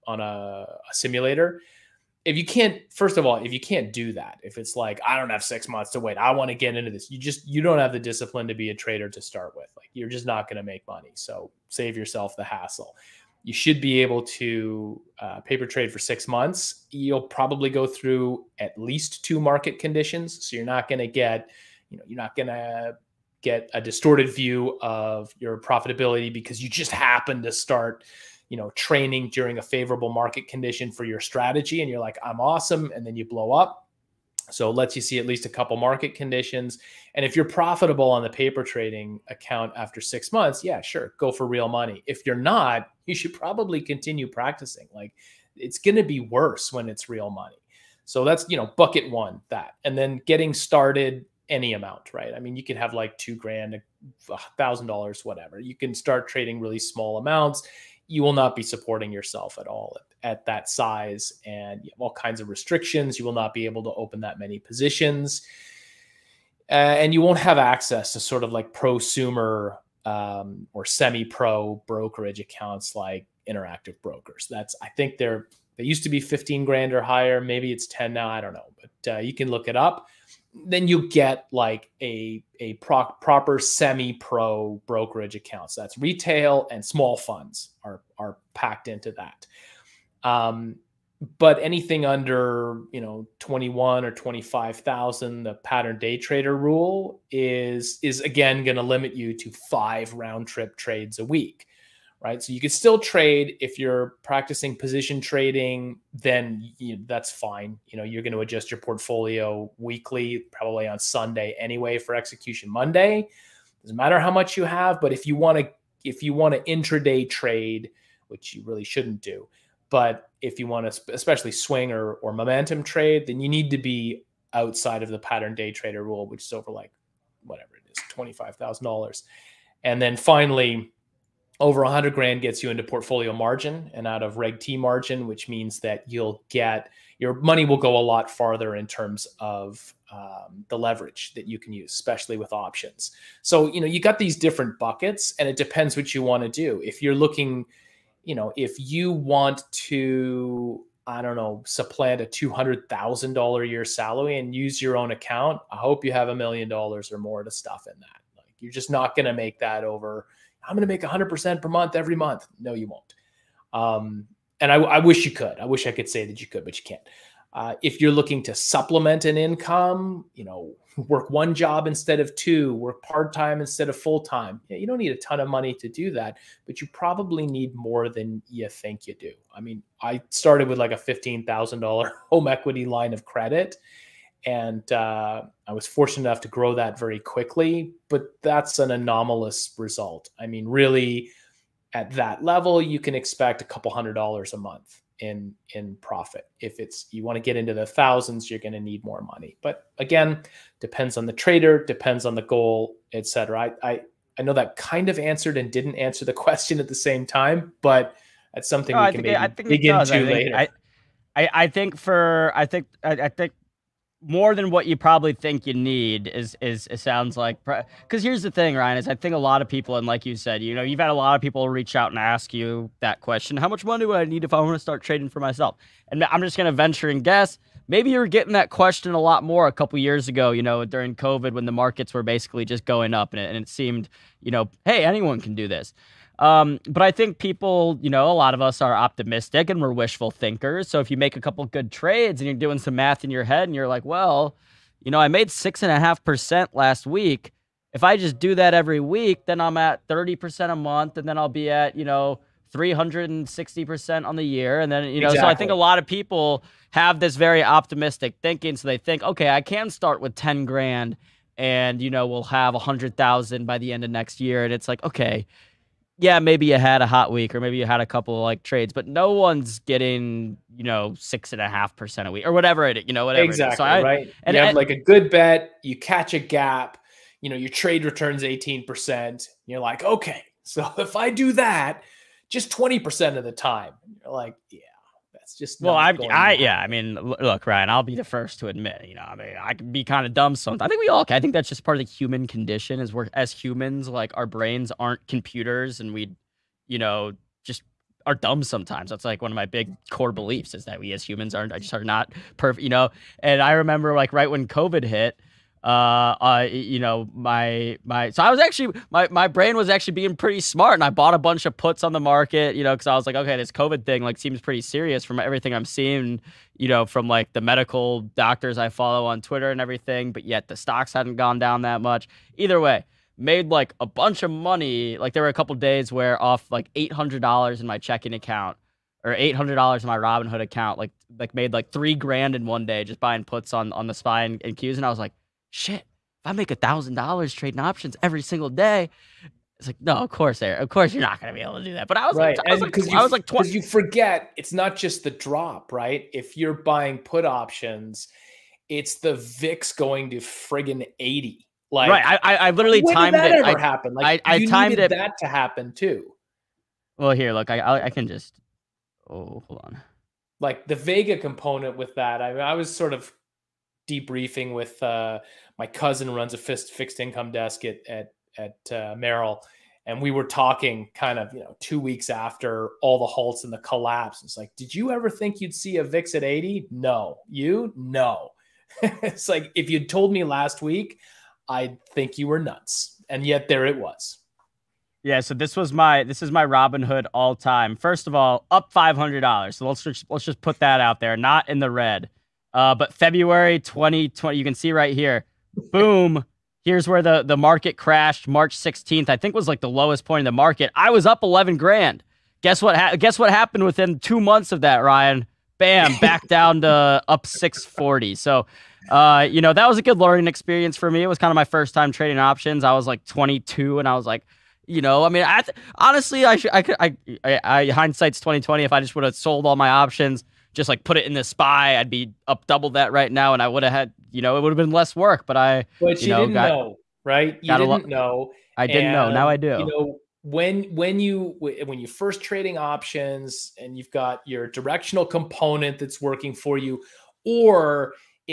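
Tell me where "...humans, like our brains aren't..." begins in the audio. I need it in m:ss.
4:53.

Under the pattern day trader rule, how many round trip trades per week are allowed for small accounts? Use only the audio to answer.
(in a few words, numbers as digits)
5.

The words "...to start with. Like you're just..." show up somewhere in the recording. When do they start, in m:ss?
0:09.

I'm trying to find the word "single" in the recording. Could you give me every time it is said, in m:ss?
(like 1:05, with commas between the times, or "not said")
5:38.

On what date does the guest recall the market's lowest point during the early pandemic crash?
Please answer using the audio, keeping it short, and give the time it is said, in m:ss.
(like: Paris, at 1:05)
March 16th, at 6:38.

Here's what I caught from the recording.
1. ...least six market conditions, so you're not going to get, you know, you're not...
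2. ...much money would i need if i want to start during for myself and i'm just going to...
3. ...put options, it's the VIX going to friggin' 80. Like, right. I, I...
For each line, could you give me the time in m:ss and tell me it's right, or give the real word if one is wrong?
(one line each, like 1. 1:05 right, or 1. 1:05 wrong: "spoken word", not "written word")
1. 0:18 wrong: "two", not "six"
2. 3:43 wrong: "trading", not "during"
3. 5:47 right.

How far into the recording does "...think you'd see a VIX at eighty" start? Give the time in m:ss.
6:15.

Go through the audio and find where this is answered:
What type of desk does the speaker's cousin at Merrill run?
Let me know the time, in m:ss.
6:06.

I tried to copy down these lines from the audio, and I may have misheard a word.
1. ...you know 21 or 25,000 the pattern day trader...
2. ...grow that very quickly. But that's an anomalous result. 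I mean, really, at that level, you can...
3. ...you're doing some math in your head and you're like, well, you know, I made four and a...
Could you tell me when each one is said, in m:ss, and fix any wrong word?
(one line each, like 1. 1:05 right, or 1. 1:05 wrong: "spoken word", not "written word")
1. 1:32 right
2. 3:06 right
3. 4:02 wrong: "six", not "four".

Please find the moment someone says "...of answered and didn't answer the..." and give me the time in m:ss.
3:25.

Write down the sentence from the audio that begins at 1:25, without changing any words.
So that's retail and small funds are are packed into that.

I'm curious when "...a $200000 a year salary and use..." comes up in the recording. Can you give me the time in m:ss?
2:32.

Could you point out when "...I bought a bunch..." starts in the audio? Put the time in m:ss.
5:11.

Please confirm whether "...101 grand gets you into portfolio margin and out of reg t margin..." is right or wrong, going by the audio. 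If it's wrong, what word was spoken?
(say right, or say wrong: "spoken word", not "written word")
wrong: "100", not "101".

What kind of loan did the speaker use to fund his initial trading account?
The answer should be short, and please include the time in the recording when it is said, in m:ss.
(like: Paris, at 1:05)
home equity line of credit, at 3:02.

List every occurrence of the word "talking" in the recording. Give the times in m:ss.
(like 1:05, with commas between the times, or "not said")
6:10.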